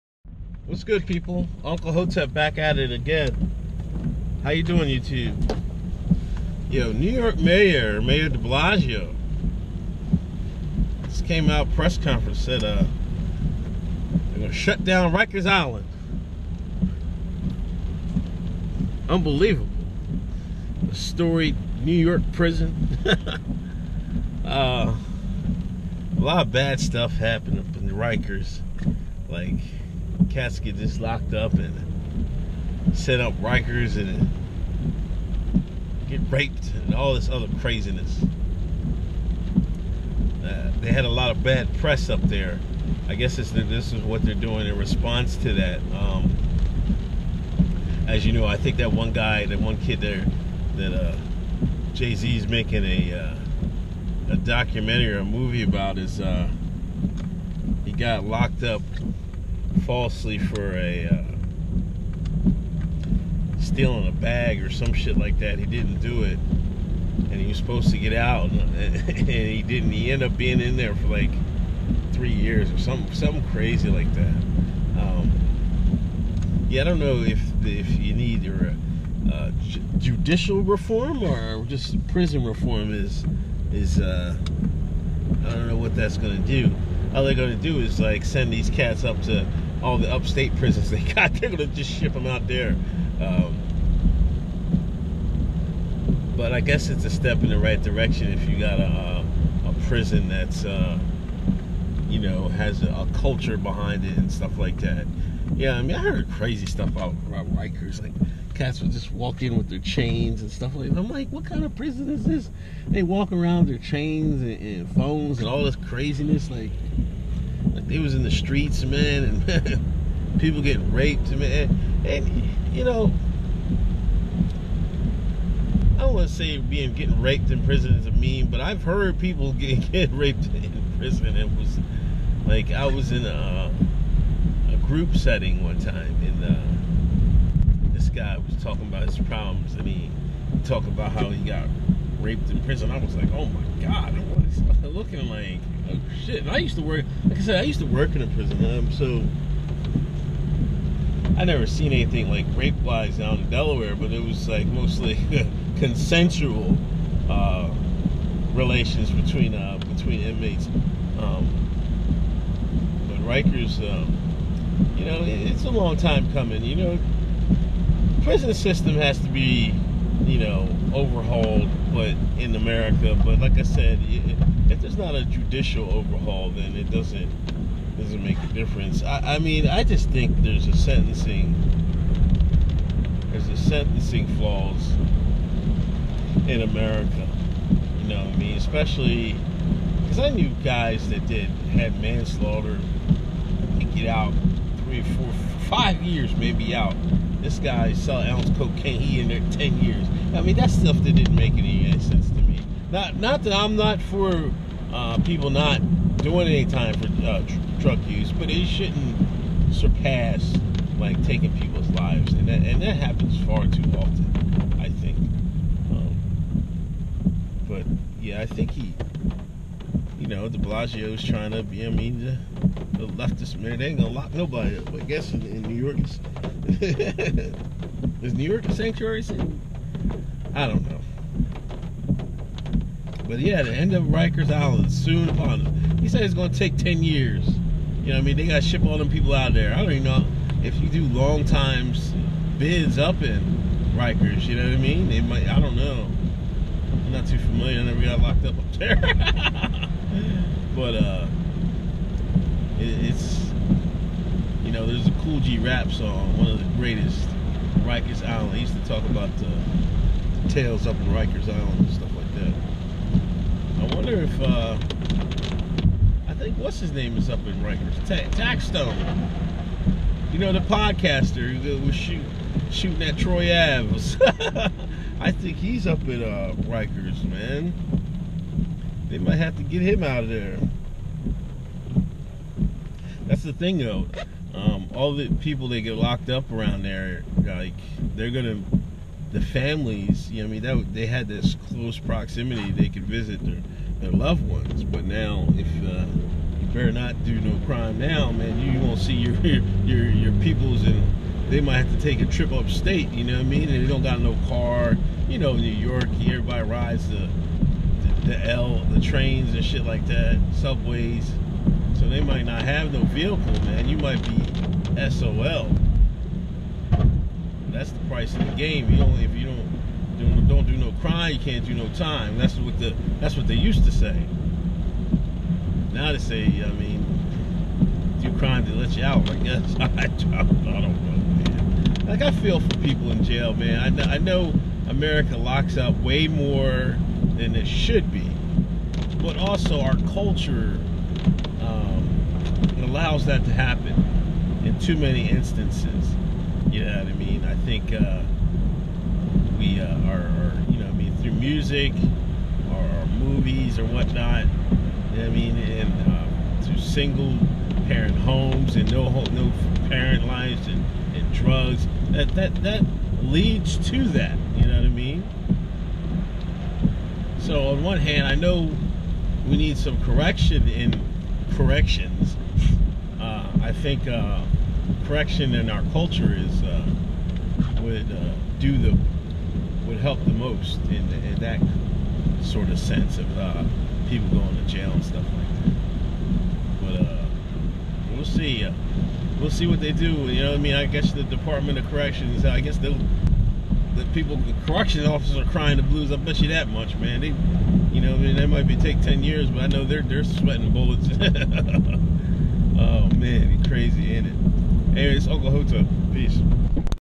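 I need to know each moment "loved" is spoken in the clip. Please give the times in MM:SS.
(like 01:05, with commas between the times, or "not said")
04:54.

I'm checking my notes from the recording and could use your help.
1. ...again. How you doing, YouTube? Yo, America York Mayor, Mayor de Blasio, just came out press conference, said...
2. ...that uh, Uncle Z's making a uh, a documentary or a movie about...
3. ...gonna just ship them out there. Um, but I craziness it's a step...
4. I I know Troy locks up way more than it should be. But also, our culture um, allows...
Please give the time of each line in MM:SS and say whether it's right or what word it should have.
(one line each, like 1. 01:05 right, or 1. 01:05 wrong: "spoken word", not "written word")
1. 00:02 wrong: "New", not "America"
2. 00:50 wrong: "Jay", not "Uncle"
3. 01:31 wrong: "guess", not "craziness"
4. 05:33 wrong: "America", not "Troy".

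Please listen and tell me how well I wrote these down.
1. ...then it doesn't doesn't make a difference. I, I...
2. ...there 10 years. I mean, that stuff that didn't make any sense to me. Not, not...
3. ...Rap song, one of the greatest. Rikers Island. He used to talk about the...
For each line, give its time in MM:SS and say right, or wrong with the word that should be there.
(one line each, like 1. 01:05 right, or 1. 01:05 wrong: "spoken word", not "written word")
1. 02:56 right
2. 03:19 right
3. 04:15 right.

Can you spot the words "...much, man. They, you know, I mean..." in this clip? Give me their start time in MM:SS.
06:36.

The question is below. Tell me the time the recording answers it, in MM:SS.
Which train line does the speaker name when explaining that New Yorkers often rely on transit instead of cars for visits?
05:08.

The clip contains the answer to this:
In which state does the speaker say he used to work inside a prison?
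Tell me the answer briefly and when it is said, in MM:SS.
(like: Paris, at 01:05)
Delaware, at 02:33.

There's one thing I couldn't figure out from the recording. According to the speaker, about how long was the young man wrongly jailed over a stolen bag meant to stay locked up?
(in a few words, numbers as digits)
3 years.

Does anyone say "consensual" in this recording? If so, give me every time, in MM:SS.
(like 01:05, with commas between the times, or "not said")
02:35.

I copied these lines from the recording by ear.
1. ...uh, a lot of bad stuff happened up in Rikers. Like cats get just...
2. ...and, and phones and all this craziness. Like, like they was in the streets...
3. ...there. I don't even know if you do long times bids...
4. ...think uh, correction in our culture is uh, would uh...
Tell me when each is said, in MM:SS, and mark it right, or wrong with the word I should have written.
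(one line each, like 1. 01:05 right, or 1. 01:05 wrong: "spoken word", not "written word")
1. 00:24 right
2. 01:54 right
3. 03:59 right
4. 06:13 right.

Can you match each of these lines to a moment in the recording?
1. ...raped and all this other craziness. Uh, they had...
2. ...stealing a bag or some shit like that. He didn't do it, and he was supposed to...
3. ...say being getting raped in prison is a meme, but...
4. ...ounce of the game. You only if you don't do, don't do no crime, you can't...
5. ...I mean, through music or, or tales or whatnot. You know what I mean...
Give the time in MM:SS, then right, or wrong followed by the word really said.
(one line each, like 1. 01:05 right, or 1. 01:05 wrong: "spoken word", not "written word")
1. 00:36 right
2. 01:03 right
3. 02:06 right
4. 05:18 wrong: "price", not "ounce"
5. 05:50 wrong: "movies", not "tales".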